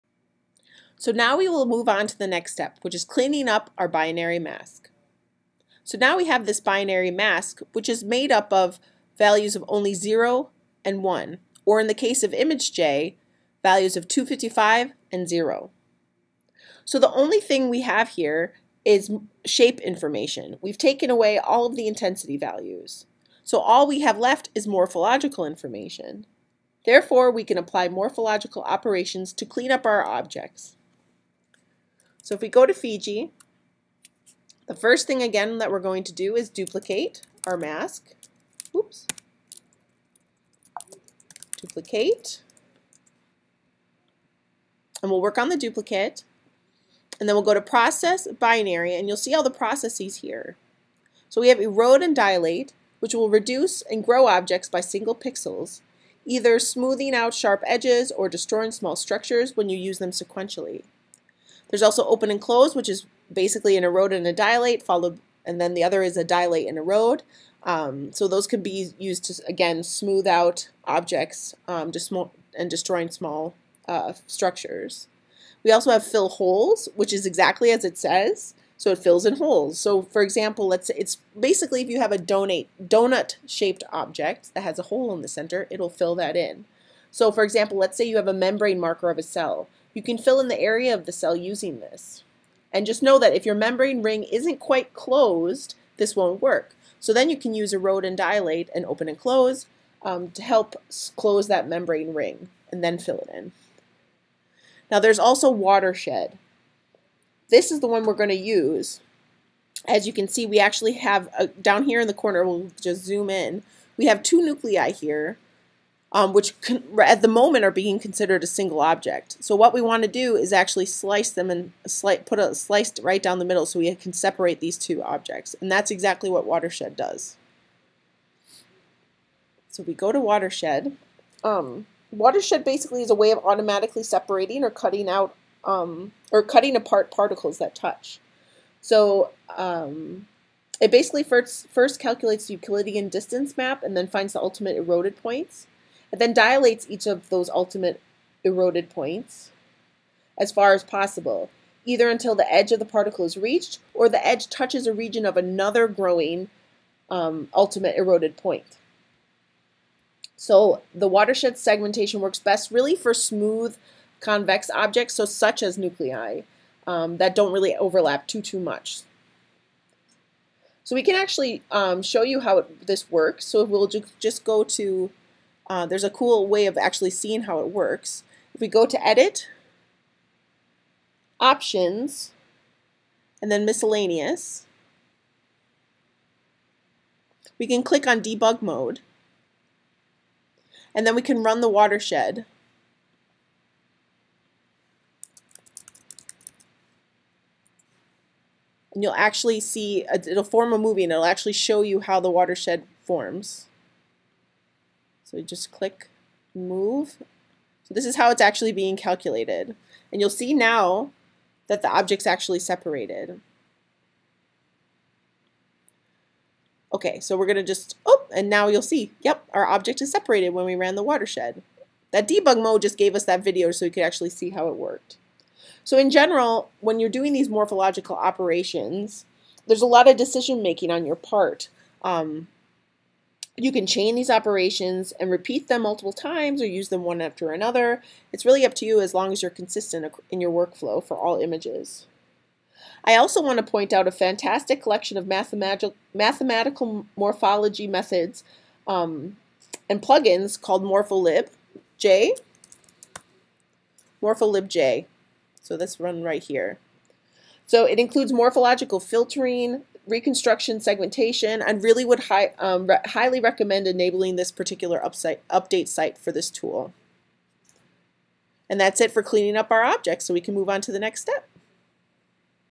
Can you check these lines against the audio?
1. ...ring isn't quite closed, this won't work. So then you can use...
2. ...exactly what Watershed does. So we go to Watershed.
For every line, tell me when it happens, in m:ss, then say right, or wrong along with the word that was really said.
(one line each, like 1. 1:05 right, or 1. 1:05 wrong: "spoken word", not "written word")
1. 1:34 right
2. 2:05 right.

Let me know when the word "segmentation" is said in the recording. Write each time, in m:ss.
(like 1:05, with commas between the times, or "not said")
2:41, 4:20.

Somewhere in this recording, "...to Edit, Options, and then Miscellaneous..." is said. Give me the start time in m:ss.
2:58.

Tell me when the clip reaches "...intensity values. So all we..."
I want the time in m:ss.
0:21.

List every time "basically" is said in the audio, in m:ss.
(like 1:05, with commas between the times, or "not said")
1:03, 1:21, 2:12, 2:20.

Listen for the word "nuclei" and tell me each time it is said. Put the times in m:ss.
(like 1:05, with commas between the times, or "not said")
1:54, 2:45.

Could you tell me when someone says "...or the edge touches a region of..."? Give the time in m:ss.
2:33.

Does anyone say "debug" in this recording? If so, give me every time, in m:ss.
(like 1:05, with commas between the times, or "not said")
3:08, 3:42.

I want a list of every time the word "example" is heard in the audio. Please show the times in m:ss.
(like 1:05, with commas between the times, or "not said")
1:20, 1:27.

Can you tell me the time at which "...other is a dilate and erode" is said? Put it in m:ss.
1:05.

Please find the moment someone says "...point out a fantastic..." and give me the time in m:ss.
4:03.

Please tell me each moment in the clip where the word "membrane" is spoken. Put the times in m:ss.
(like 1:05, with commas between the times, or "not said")
1:28, 1:33, 1:41.